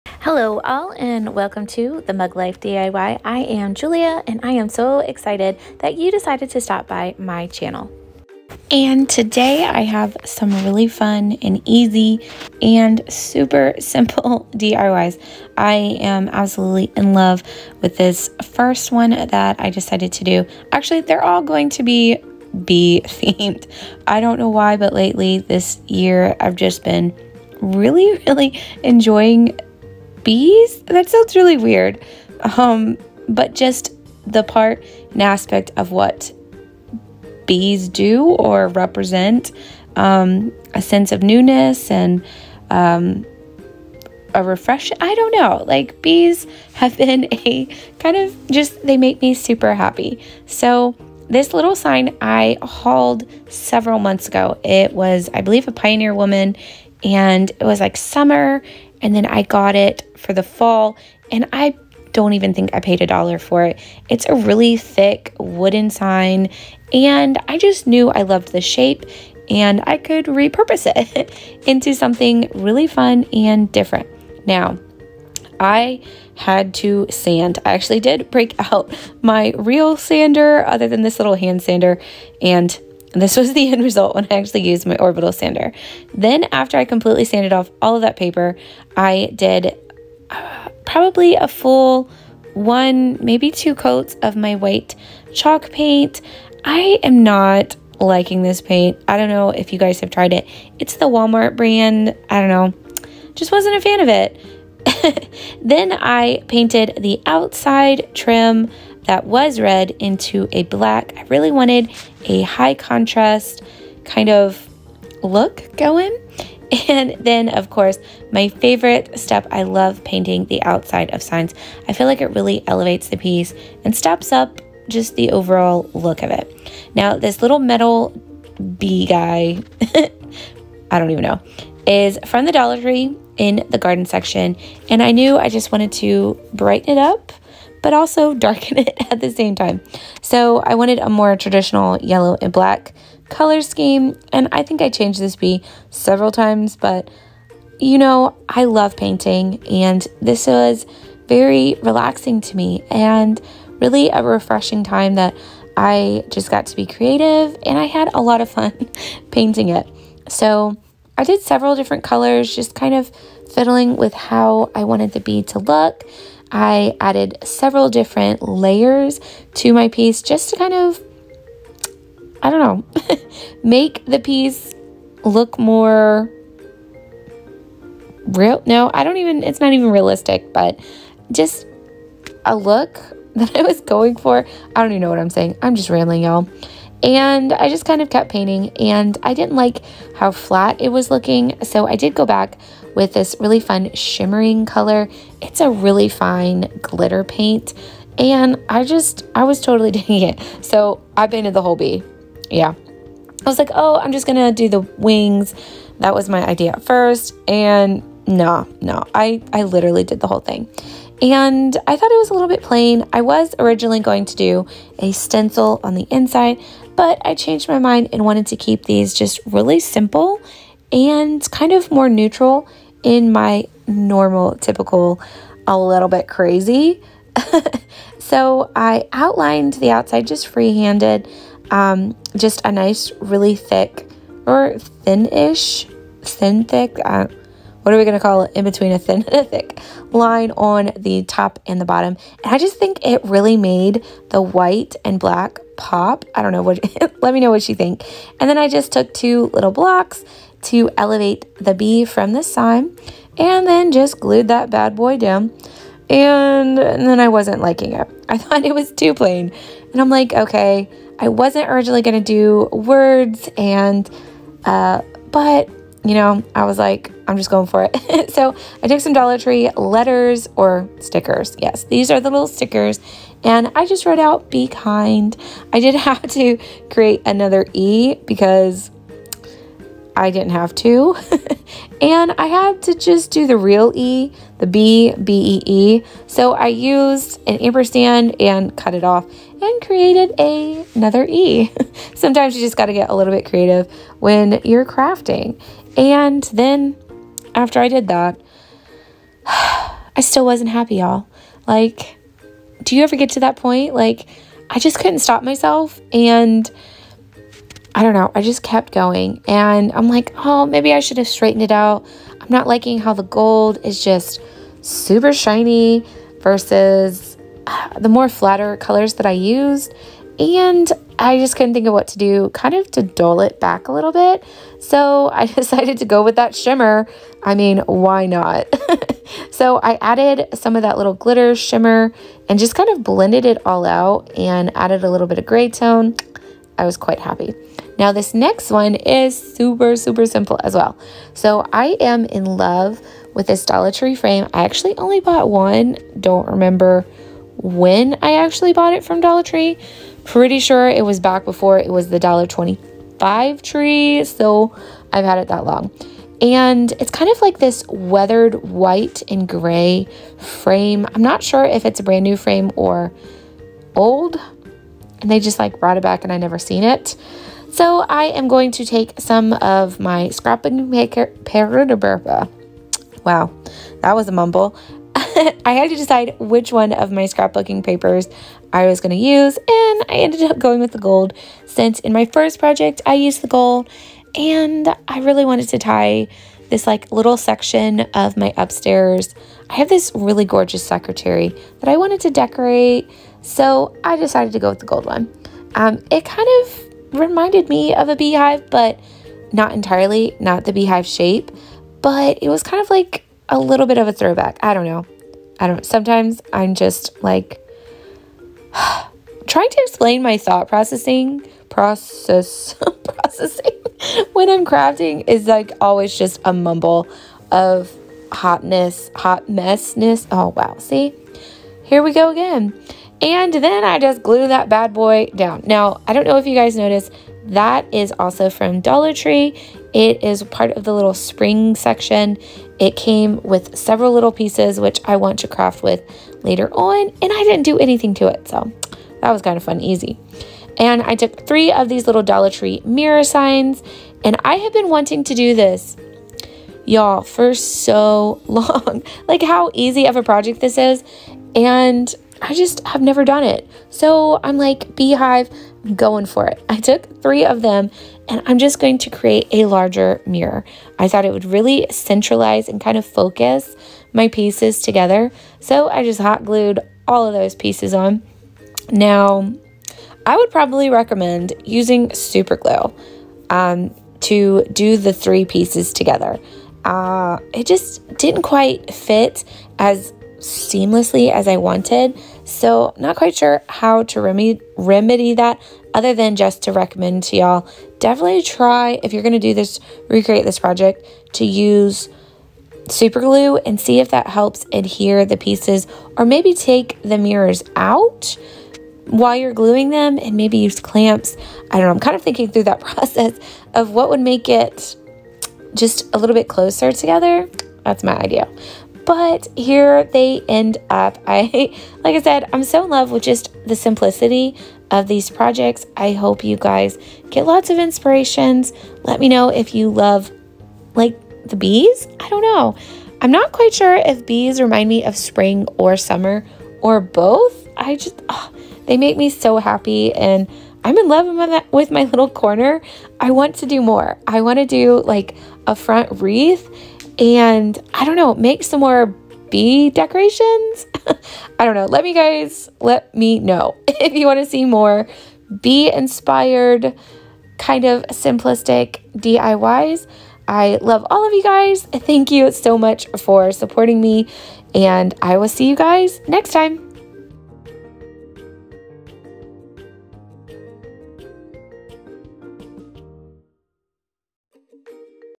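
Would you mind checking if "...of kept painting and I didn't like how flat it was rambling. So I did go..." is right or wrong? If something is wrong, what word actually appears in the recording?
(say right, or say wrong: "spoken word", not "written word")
wrong: "looking", not "rambling".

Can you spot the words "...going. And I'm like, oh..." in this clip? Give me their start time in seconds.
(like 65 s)
308 s.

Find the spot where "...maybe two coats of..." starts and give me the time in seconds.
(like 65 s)
93 s.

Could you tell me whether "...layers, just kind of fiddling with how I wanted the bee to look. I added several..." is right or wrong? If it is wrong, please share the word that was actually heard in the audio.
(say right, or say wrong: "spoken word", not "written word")
wrong: "colors", not "layers".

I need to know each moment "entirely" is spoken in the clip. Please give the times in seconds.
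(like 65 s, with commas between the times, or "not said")
399 s.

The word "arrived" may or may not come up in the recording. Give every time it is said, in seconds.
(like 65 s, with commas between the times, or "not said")
not said.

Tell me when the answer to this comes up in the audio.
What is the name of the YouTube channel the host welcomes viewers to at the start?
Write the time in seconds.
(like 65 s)
2 s.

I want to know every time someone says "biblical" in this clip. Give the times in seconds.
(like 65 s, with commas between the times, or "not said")
not said.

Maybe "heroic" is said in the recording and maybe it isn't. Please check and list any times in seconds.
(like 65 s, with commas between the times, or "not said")
not said.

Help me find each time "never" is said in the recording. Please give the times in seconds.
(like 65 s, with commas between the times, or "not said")
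366 s, 453 s.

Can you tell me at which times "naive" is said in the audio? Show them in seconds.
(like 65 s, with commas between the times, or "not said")
not said.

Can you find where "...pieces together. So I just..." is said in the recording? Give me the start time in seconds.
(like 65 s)
464 s.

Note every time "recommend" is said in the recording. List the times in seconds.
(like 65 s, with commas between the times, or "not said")
470 s, 486 s.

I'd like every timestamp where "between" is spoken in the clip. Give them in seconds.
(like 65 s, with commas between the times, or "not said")
238 s.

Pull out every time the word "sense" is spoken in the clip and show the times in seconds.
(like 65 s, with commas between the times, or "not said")
40 s.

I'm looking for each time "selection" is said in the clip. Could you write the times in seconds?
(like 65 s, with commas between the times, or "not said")
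not said.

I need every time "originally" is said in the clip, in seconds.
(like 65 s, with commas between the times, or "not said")
213 s, 261 s.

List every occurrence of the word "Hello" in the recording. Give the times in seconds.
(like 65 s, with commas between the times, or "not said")
0 s.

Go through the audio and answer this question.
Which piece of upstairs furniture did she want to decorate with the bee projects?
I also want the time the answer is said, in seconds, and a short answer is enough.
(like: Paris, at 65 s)
Secretary, at 390 s.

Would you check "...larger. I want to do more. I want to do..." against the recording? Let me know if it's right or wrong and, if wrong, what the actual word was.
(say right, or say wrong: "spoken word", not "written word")
wrong: "corner", not "larger".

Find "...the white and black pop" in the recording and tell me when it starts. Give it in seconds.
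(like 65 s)
244 s.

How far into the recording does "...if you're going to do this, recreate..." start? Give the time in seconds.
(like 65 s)
489 s.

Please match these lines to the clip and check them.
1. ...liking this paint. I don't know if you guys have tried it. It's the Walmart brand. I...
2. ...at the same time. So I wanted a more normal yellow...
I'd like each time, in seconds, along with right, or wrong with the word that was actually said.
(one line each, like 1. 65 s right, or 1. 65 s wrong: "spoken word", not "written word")
1. 97 s right
2. 139 s wrong: "traditional", not "normal".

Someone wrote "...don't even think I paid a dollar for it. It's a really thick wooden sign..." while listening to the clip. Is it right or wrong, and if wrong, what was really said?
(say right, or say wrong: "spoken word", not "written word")
right.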